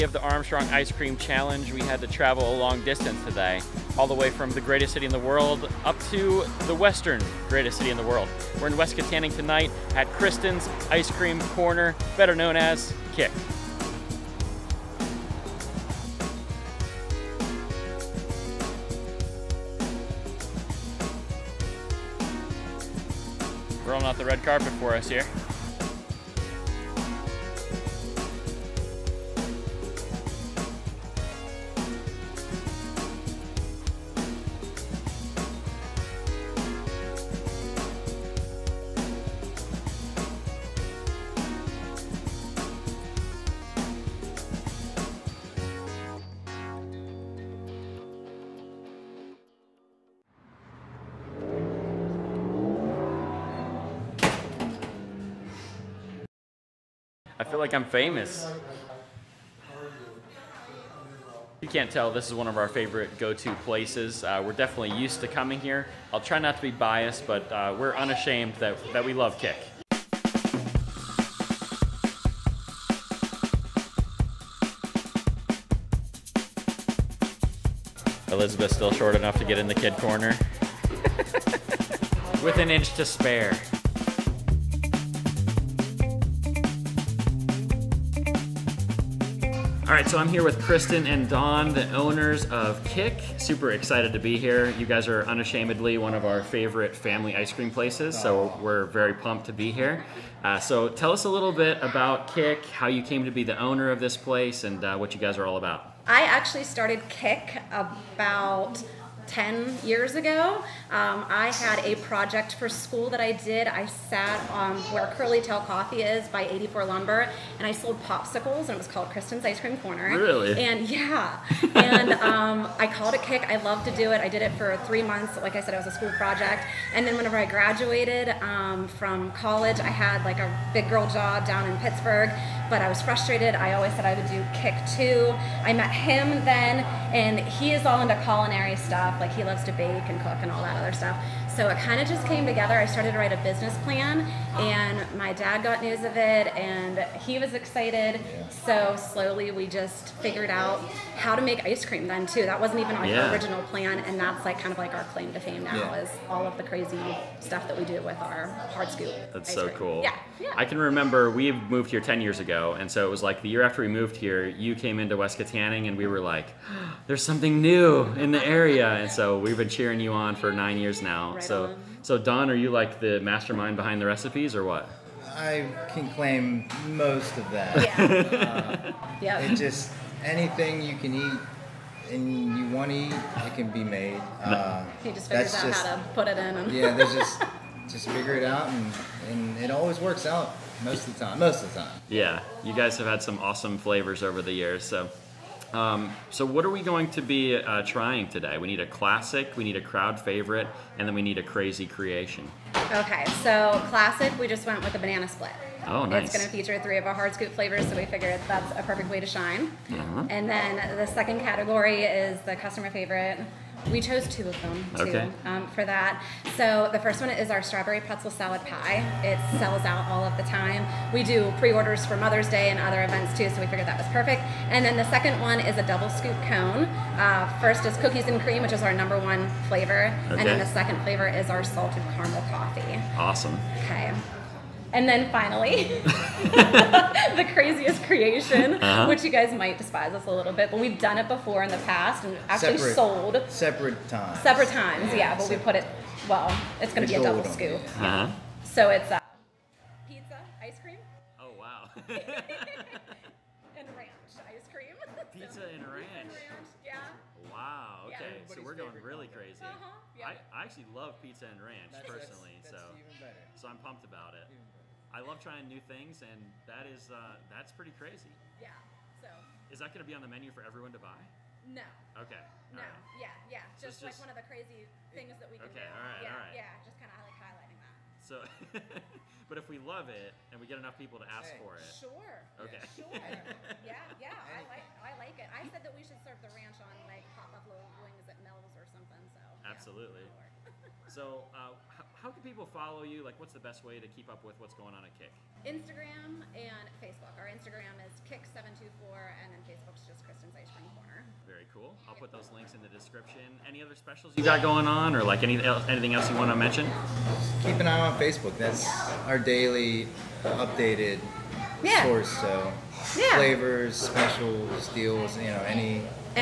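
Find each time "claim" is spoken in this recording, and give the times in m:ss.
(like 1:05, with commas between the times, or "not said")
2:35, 2:56.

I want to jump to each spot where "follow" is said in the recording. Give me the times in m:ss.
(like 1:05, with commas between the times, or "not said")
4:52.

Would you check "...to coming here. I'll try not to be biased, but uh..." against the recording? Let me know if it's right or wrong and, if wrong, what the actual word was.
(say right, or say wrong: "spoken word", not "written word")
right.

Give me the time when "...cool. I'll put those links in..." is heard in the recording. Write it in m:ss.
5:01.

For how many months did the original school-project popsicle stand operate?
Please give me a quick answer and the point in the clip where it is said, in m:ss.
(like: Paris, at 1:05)
3, at 2:04.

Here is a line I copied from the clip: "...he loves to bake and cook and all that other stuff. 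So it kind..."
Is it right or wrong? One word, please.
right.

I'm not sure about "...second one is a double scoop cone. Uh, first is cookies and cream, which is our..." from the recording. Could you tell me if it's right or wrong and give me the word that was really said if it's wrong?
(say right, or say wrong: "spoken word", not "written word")
right.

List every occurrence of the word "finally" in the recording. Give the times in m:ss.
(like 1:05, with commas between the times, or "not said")
3:55.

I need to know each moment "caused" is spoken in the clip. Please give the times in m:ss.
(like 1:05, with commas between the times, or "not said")
not said.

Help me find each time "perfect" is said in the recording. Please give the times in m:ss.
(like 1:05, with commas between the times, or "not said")
3:28, 3:44.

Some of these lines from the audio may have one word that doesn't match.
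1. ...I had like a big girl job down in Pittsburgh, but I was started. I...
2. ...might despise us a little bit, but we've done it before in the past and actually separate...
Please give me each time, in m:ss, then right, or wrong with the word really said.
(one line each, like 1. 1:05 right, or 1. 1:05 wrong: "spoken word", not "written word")
1. 2:09 wrong: "frustrated", not "started"
2. 3:59 right.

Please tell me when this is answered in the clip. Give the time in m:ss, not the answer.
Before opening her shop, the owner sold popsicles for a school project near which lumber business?
1:56.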